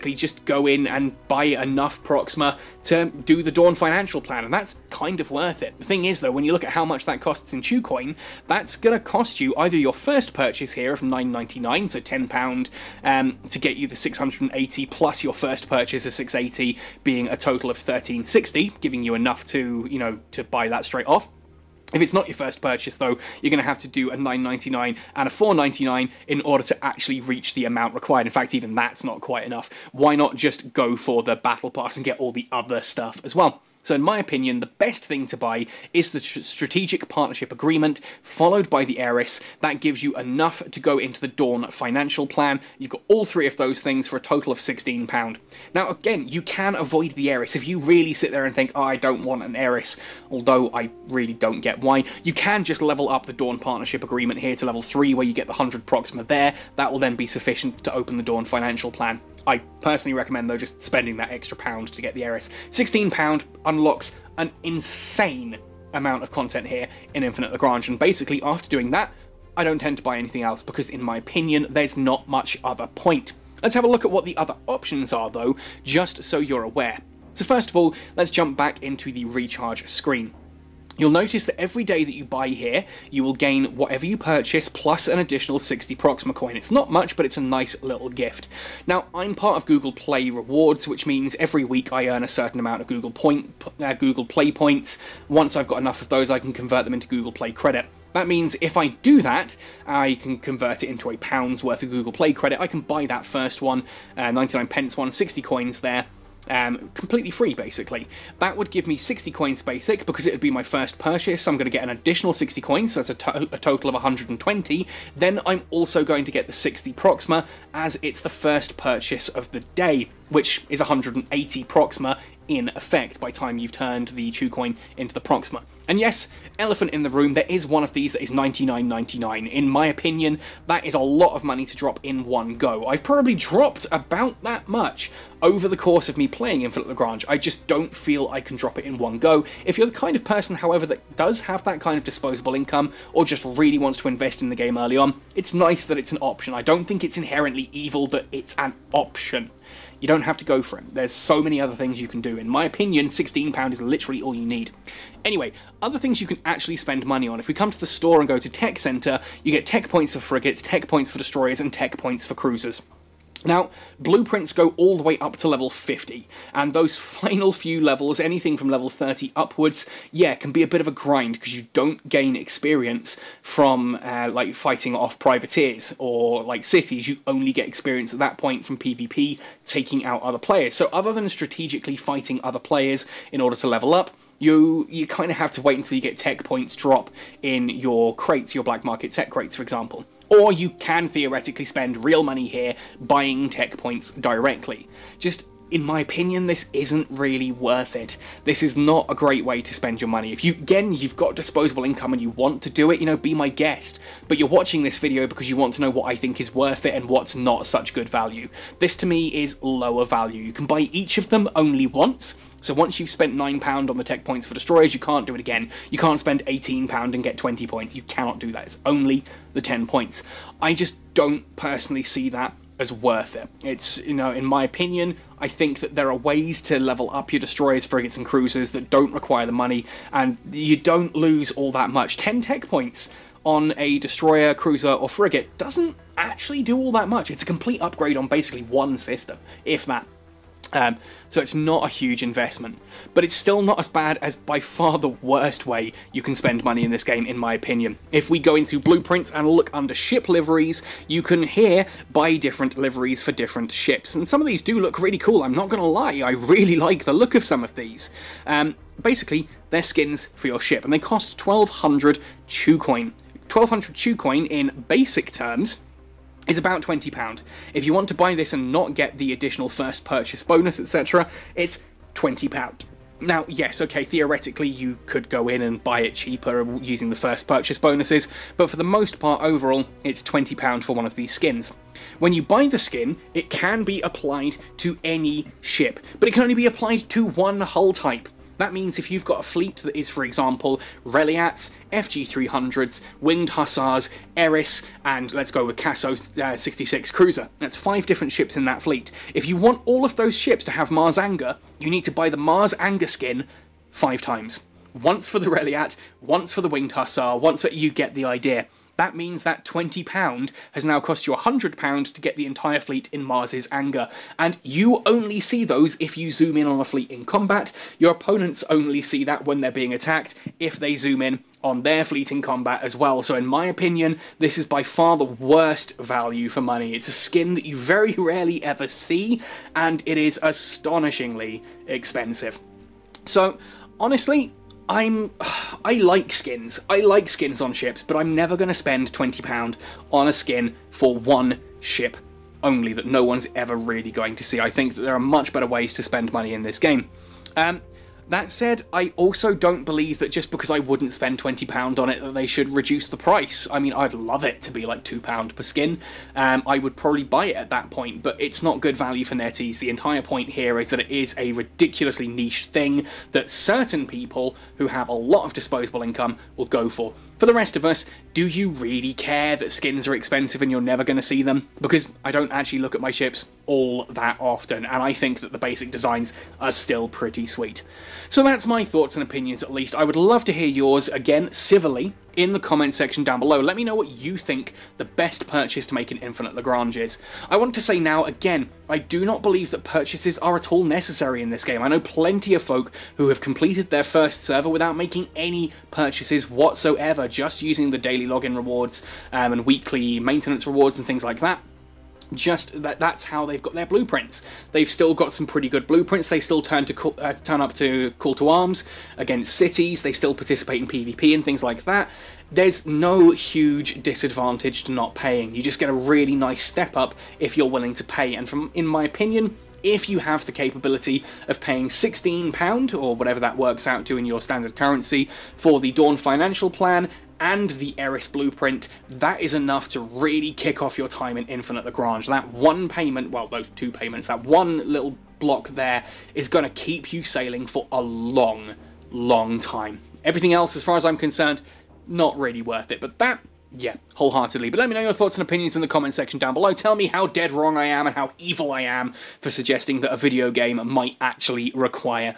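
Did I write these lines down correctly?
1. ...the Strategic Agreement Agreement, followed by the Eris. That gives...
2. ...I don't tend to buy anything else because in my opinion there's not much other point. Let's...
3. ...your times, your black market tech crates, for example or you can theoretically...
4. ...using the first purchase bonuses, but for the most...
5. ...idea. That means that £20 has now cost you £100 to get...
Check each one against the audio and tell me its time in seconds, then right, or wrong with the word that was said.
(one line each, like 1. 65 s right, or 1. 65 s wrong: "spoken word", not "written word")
1. 36 s wrong: "Partnership", not "Agreement"
2. 69 s right
3. 187 s wrong: "crates", not "times"
4. 276 s right
5. 308 s right.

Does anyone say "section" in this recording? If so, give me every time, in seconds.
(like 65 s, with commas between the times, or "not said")
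382 s, 446 s.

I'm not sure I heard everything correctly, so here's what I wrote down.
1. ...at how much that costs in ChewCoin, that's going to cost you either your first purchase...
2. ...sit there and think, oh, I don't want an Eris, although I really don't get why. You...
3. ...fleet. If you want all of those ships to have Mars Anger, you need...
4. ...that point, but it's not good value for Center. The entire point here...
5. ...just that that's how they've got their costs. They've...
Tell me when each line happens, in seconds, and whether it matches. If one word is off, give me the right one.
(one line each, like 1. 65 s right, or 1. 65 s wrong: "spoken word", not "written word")
1. 6 s right
2. 48 s right
3. 298 s right
4. 357 s wrong: "NetEase", not "Center"
5. 402 s wrong: "blueprints", not "costs".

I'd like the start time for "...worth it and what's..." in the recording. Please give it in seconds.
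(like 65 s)
206 s.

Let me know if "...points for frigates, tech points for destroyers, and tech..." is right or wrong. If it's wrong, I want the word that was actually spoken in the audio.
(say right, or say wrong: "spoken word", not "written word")
right.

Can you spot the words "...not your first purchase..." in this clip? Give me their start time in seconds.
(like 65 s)
22 s.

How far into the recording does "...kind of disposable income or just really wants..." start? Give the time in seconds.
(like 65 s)
141 s.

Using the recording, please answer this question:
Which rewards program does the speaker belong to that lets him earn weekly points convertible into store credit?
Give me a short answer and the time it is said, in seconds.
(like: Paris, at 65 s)
Google Play Rewards, at 89 s.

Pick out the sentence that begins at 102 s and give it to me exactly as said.
I can buy that first one, uh, 99 pence one, 60 coins there, um, completely free basically.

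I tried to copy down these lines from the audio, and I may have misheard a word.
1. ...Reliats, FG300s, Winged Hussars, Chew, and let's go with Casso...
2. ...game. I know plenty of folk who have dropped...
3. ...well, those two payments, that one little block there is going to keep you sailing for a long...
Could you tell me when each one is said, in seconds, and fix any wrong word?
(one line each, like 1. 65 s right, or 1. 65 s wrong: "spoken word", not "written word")
1. 291 s wrong: "Eris", not "Chew"
2. 391 s wrong: "completed", not "dropped"
3. 433 s right.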